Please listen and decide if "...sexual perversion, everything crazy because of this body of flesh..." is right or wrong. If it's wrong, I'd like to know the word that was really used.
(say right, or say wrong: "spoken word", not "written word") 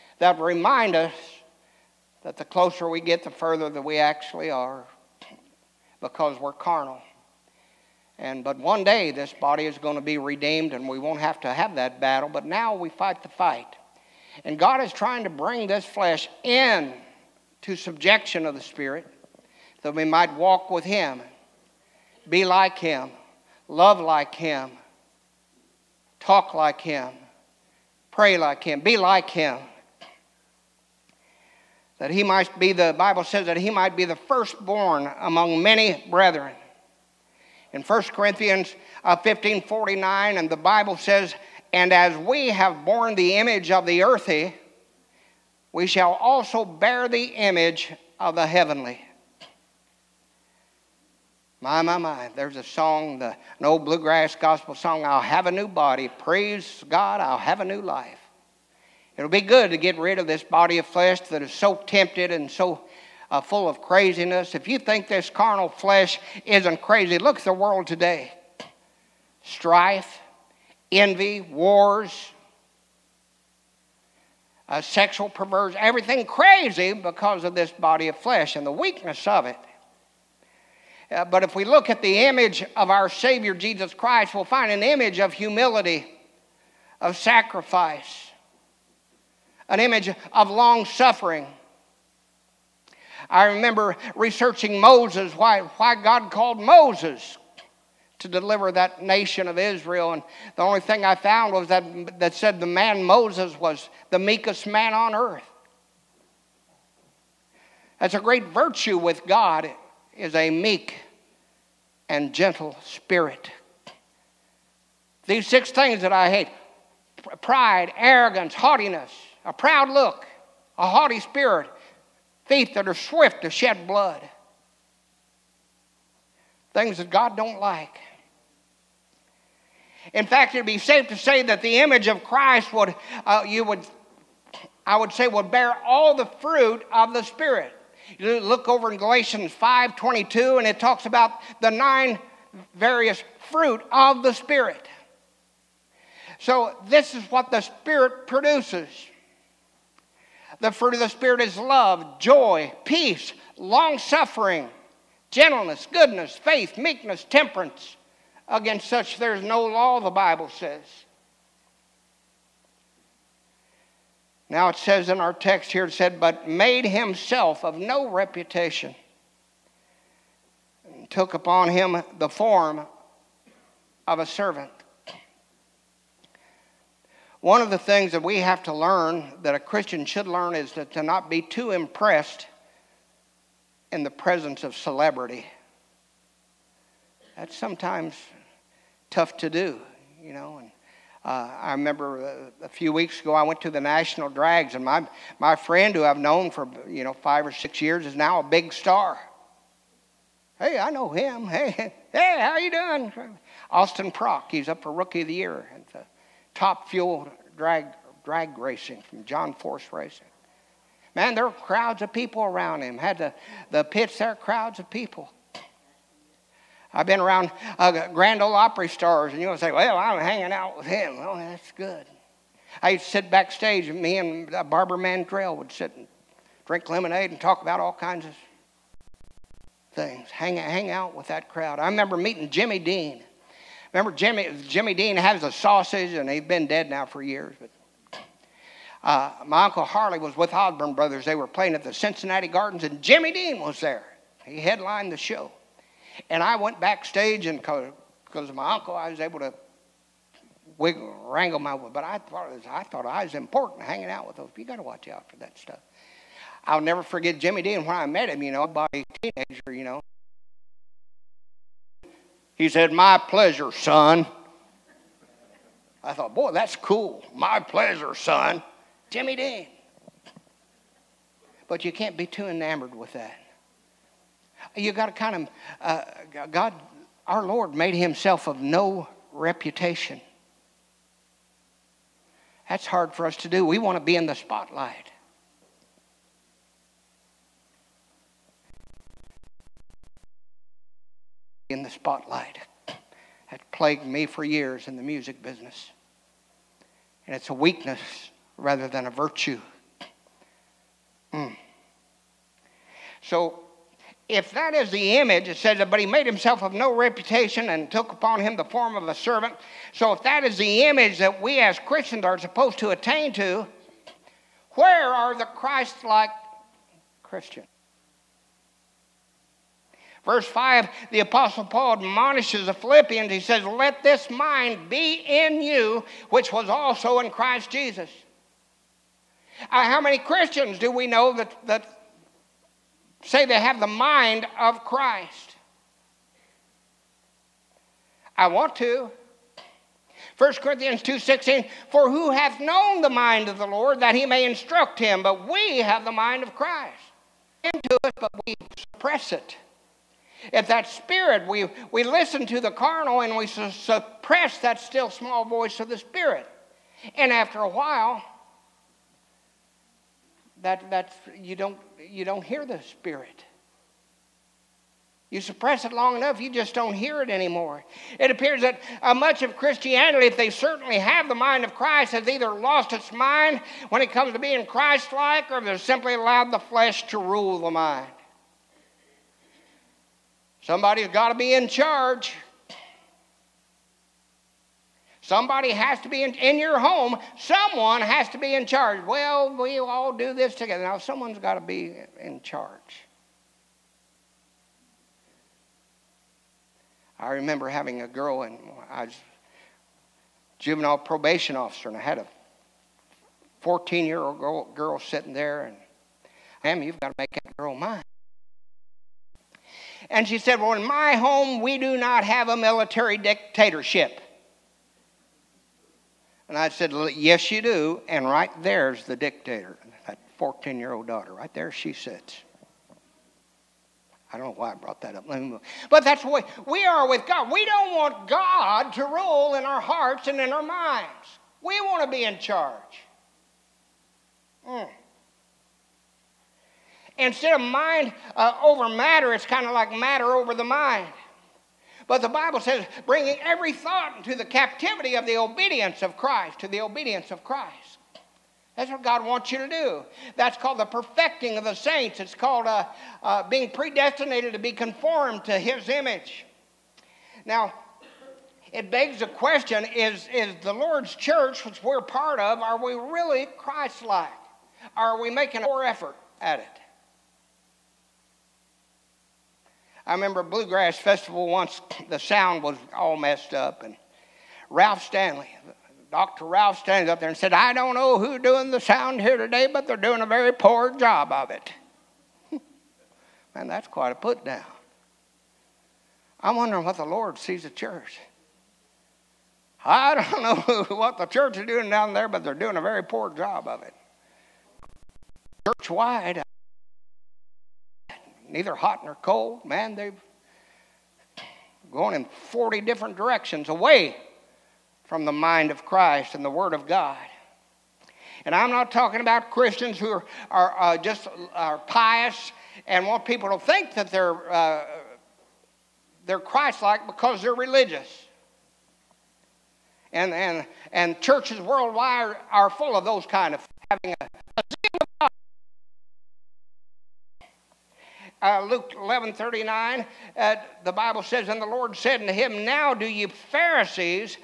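right.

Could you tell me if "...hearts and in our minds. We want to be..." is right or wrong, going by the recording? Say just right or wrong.
right.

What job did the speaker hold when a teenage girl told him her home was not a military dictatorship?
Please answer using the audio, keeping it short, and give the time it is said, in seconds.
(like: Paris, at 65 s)
Juvenile probation officer, at 400 s.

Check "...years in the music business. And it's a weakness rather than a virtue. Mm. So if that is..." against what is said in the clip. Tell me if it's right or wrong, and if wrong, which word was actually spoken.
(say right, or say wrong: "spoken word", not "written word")
right.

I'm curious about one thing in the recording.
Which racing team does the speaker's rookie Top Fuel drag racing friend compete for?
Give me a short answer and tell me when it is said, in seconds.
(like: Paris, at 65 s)
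John Force Racing, at 209 s.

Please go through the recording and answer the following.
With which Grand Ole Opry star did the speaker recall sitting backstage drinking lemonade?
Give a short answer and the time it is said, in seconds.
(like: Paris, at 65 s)
Barbara Mandrell, at 224 s.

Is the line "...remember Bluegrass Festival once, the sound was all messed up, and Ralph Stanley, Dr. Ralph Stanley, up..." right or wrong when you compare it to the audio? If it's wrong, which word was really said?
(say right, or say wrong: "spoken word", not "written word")
right.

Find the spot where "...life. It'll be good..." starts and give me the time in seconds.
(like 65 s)
57 s.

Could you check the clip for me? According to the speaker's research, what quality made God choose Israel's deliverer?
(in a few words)
Meekest man on earth.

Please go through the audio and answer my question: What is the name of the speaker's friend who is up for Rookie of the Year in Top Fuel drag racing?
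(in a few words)
Austin Prock.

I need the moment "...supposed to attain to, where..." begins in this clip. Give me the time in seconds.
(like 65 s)
312 s.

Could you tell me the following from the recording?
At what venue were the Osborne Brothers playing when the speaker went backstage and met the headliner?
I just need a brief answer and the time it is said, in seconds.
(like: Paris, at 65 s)
Cincinnati Gardens, at 241 s.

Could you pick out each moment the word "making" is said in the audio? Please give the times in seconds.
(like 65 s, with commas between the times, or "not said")
465 s.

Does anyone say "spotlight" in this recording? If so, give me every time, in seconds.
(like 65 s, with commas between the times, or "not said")
284 s, 291 s.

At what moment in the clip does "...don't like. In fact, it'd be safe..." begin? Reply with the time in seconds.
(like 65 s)
127 s.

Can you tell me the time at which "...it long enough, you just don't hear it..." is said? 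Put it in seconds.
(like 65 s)
365 s.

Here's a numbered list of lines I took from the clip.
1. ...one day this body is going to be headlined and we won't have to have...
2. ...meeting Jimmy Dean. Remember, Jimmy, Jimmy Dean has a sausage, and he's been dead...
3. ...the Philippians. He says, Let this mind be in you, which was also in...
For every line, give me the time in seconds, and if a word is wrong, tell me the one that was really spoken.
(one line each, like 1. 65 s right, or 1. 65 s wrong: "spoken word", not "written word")
1. 8 s wrong: "redeemed", not "headlined"
2. 232 s right
3. 322 s right.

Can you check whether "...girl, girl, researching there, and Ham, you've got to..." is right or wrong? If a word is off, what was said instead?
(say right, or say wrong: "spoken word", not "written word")
wrong: "sitting", not "researching".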